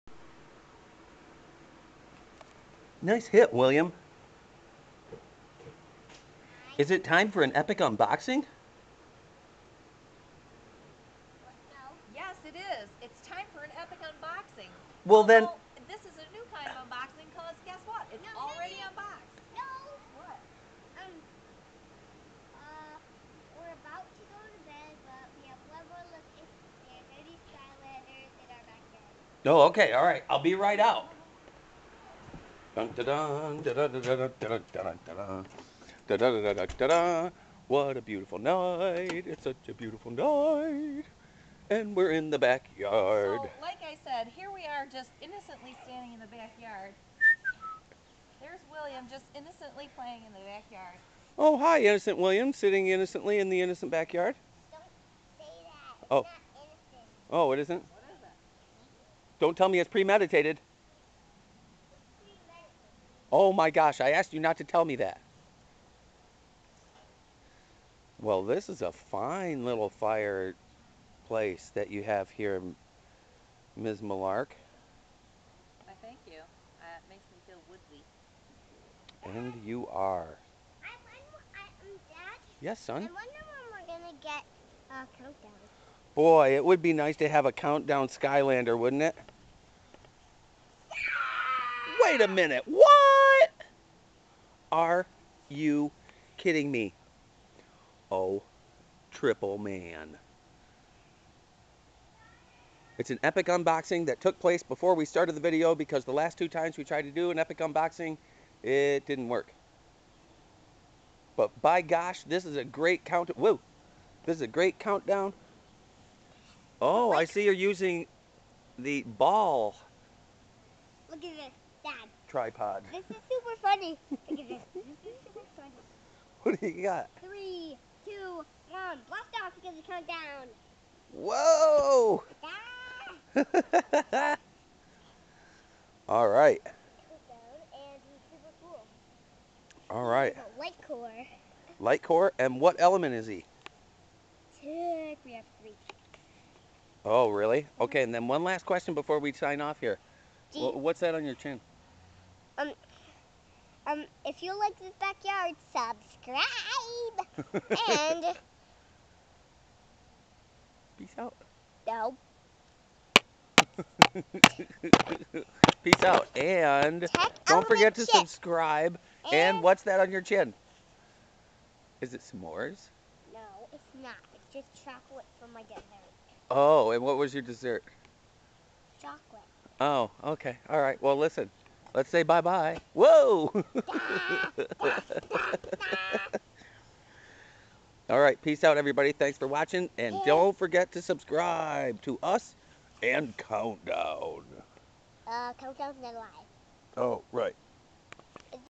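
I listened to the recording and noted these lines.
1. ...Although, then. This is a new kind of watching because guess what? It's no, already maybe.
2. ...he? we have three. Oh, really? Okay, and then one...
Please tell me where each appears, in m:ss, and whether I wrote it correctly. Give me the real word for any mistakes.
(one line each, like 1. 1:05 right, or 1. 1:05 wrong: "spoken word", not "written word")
1. 0:15 wrong: "unboxing", not "watching"
2. 2:23 right.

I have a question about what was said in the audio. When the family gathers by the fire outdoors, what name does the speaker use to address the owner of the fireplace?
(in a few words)
Ms. Malark.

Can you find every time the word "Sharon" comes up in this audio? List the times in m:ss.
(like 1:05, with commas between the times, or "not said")
not said.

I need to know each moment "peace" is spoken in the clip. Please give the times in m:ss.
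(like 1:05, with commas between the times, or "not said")
2:40, 2:45, 3:08.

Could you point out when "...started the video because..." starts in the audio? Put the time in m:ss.
1:45.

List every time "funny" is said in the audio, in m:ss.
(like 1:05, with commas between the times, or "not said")
2:03.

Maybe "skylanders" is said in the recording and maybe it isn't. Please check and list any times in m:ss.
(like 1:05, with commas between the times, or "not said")
0:27, 1:28.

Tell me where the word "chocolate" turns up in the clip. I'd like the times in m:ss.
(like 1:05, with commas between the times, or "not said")
2:54, 2:59.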